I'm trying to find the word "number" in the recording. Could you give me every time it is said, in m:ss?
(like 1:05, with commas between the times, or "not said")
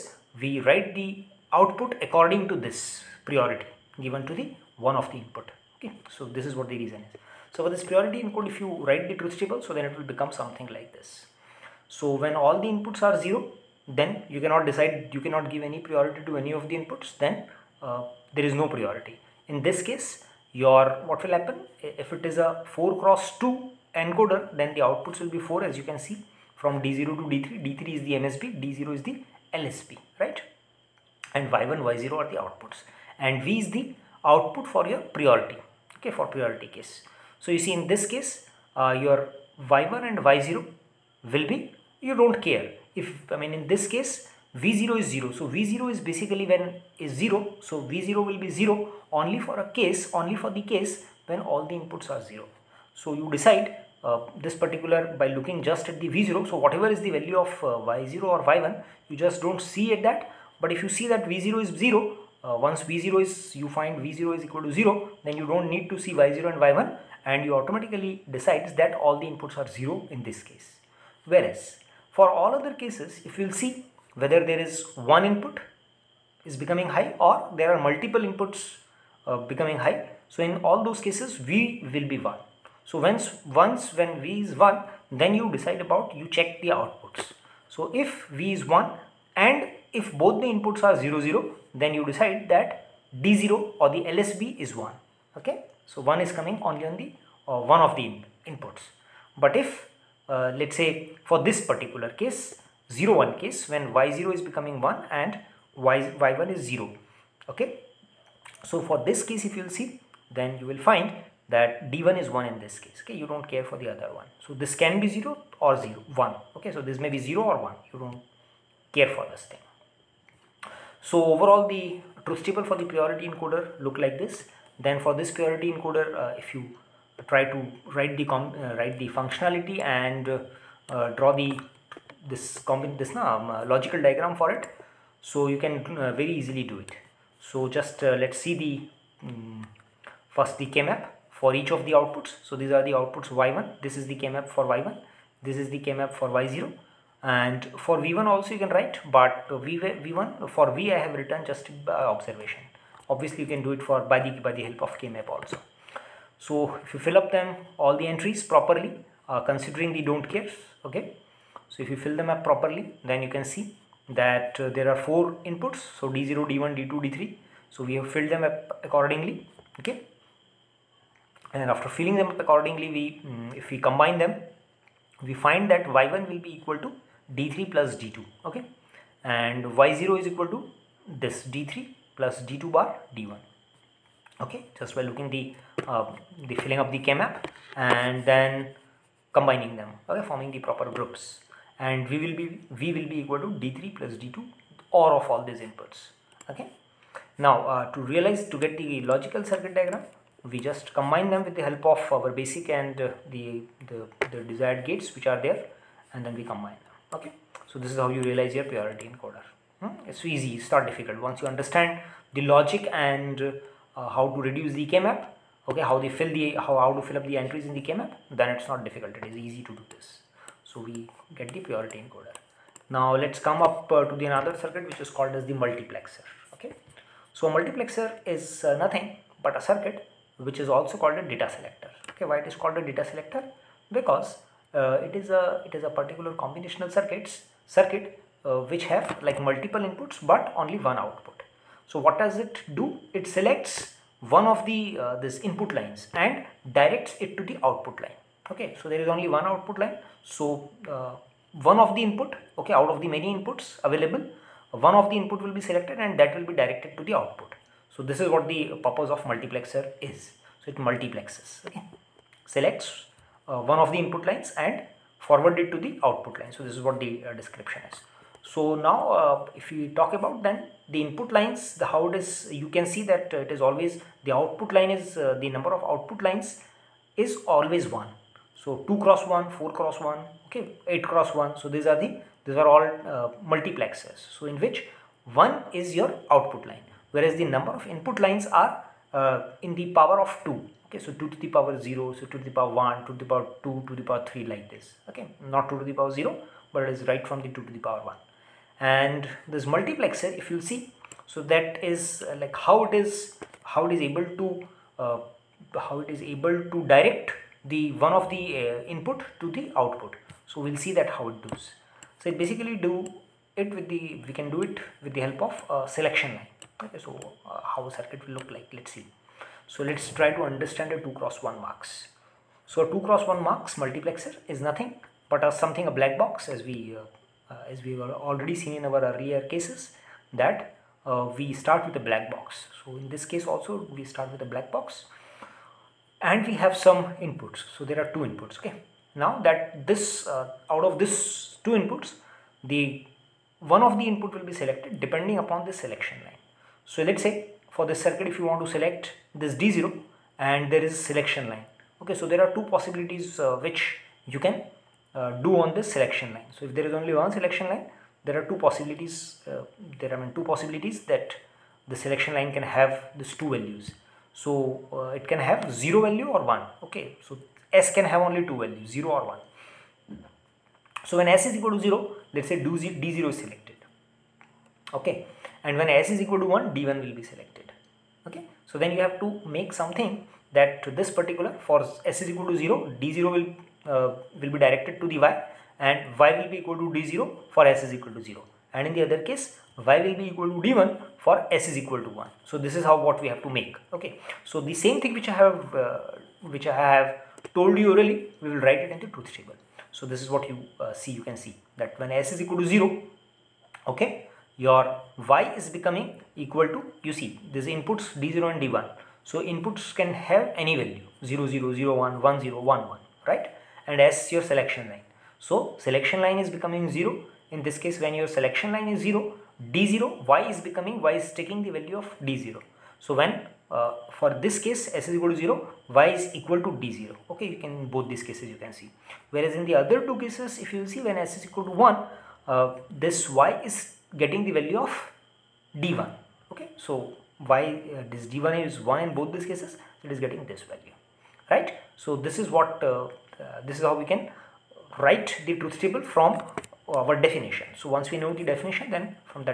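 4:35, 4:47.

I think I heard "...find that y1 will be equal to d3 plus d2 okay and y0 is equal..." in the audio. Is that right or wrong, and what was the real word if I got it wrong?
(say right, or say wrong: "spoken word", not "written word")
right.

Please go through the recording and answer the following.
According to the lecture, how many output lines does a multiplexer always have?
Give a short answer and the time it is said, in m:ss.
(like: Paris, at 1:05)
1, at 4:35.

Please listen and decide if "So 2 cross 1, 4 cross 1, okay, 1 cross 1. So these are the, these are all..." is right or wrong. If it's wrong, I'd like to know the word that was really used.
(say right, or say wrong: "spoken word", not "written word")
wrong: "8", not "1".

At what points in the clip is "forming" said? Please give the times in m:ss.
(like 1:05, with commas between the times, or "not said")
3:10.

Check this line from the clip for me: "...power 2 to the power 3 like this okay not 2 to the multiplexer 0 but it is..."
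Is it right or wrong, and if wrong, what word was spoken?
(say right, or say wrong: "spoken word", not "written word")
wrong: "power", not "multiplexer".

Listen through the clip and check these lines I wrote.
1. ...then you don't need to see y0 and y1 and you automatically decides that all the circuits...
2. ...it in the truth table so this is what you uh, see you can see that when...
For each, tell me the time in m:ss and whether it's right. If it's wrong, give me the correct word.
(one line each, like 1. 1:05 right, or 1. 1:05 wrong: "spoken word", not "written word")
1. 1:05 wrong: "inputs", not "circuits"
2. 6:38 right.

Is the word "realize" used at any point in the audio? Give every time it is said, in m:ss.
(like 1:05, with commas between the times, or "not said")
3:18, 3:28.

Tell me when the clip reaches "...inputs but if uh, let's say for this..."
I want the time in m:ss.
1:38.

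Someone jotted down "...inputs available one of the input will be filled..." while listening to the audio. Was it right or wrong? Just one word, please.
wrong.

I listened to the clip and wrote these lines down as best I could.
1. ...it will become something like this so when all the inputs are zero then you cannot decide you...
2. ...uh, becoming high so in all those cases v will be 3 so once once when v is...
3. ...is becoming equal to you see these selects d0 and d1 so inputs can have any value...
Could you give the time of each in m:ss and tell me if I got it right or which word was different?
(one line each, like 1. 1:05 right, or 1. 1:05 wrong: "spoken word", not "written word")
1. 0:09 right
2. 1:19 wrong: "1", not "3"
3. 6:45 wrong: "inputs", not "selects".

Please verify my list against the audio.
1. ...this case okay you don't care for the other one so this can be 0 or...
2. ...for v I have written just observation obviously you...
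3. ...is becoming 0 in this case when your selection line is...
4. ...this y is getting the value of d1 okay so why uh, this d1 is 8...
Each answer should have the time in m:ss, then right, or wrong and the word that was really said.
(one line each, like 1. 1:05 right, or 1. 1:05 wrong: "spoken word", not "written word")
1. 1:52 right
2. 2:30 right
3. 6:56 right
4. 7:13 wrong: "1", not "8".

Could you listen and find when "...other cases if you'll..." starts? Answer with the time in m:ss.
1:12.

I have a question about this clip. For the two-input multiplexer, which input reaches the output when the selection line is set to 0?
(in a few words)
D0.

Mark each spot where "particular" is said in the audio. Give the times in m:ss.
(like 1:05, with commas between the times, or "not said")
0:54, 1:41, 3:55, 6:21.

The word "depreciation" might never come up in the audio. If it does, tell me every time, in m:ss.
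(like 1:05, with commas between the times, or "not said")
not said.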